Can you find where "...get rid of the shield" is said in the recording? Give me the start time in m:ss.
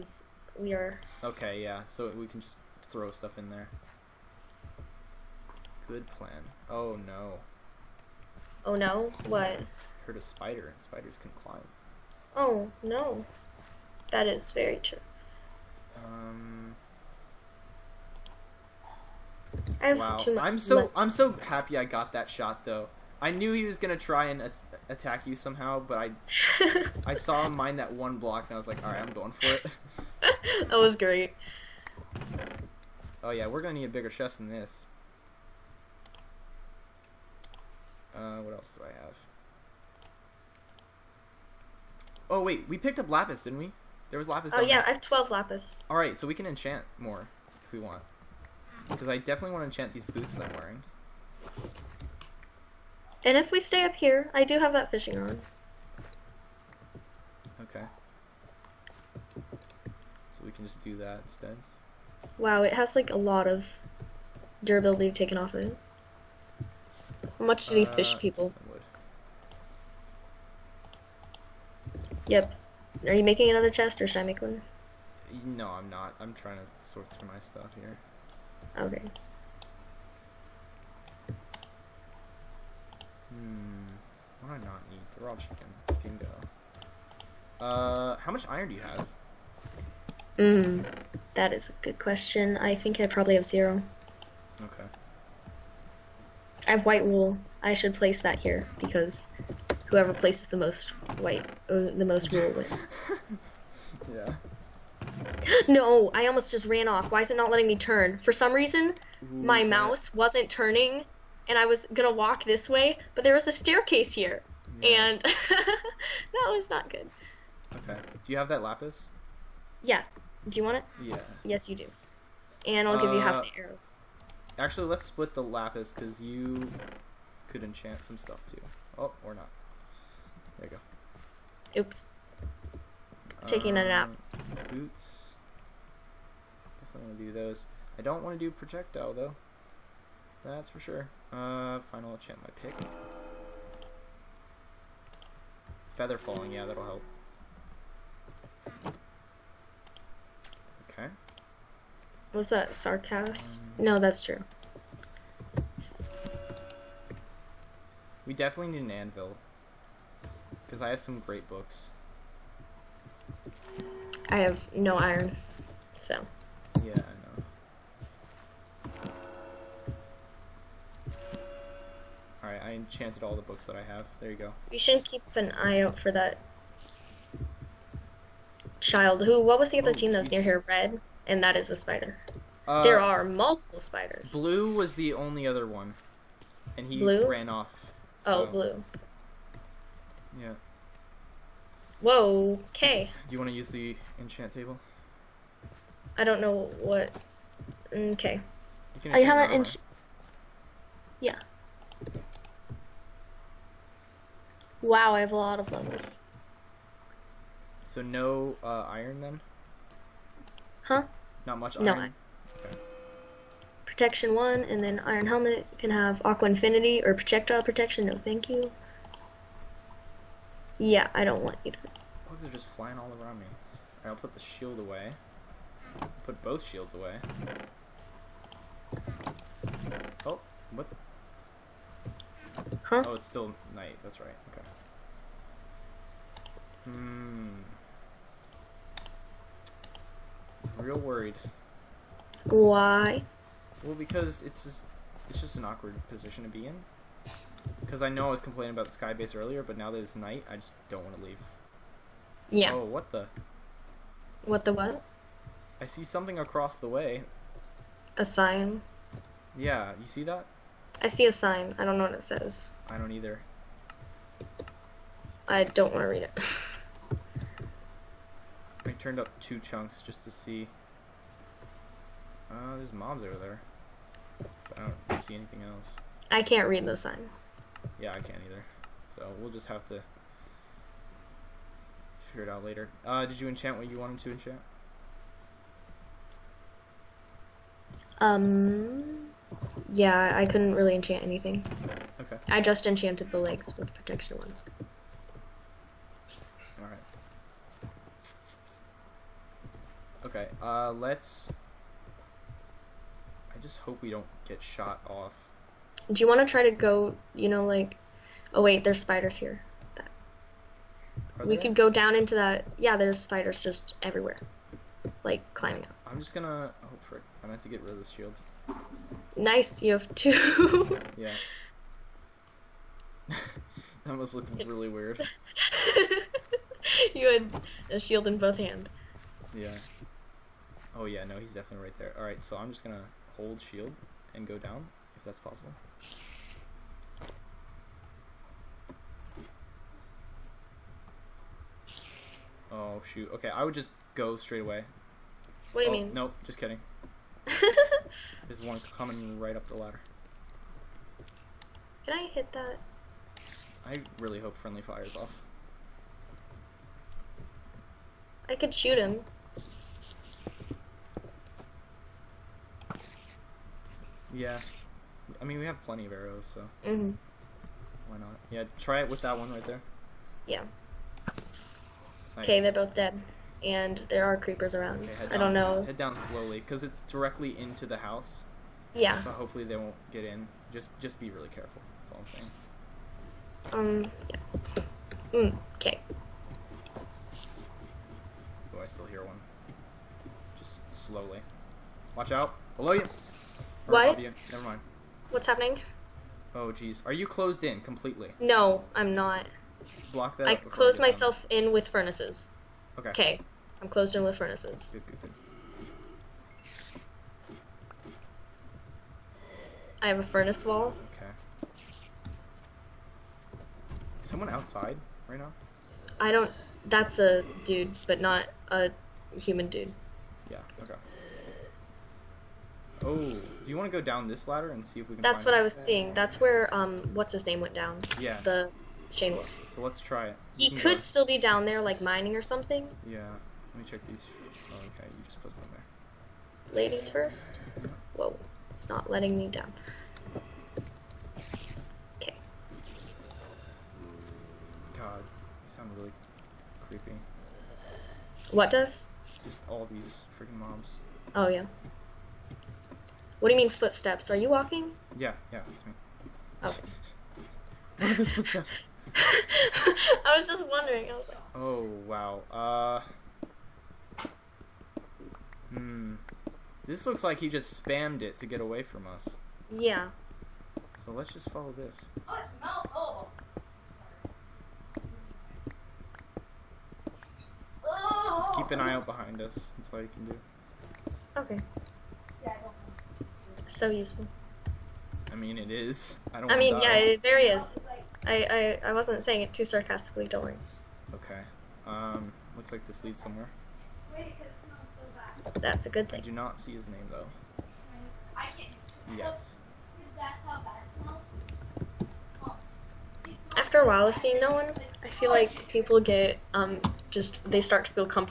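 5:17.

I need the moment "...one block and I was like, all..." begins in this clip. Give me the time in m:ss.
0:27.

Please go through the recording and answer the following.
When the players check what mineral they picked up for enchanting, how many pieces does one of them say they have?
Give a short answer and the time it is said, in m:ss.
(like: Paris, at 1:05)
12, at 0:44.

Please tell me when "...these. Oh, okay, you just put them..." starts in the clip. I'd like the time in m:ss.
7:14.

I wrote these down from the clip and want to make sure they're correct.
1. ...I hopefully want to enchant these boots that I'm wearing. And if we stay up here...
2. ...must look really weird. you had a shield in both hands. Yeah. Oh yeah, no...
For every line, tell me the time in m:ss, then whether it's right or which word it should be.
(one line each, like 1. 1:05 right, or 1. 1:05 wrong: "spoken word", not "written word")
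1. 0:49 wrong: "definitely", not "hopefully"
2. 5:24 right.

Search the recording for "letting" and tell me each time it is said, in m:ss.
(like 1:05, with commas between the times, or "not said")
1:47, 7:19.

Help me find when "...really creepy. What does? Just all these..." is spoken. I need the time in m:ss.
7:25.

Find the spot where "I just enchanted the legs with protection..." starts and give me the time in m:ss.
4:52.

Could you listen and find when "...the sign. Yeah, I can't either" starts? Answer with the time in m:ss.
4:36.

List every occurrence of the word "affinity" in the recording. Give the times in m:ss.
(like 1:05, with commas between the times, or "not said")
3:36.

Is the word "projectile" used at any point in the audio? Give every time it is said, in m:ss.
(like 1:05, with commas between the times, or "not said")
2:18, 3:37.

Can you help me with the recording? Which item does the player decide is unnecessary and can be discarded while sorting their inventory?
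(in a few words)
Raw chicken.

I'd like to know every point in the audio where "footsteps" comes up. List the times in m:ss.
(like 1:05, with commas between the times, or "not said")
7:33, 7:38.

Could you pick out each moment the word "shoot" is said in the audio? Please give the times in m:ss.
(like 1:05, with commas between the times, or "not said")
5:43, 5:58.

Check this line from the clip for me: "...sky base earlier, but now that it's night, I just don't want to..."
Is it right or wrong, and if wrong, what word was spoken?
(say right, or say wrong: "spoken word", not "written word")
right.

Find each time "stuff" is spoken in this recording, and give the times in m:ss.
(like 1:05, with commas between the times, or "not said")
0:03, 1:17, 2:08.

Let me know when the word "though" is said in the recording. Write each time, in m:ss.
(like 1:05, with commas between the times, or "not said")
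0:22, 2:19, 8:17.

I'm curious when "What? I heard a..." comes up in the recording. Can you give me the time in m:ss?
0:09.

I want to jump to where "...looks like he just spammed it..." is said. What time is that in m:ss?
7:47.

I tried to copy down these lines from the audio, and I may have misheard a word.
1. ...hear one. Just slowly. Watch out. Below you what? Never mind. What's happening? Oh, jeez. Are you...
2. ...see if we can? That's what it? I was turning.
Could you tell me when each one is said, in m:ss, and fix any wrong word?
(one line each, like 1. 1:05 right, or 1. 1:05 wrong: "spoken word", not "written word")
1. 6:29 right
2. 7:04 wrong: "seeing", not "turning".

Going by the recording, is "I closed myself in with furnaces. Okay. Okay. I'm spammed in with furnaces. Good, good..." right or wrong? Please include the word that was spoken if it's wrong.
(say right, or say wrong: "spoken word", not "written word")
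wrong: "closed", not "spammed".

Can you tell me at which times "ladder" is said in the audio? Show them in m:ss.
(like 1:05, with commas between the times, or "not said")
5:49, 7:04.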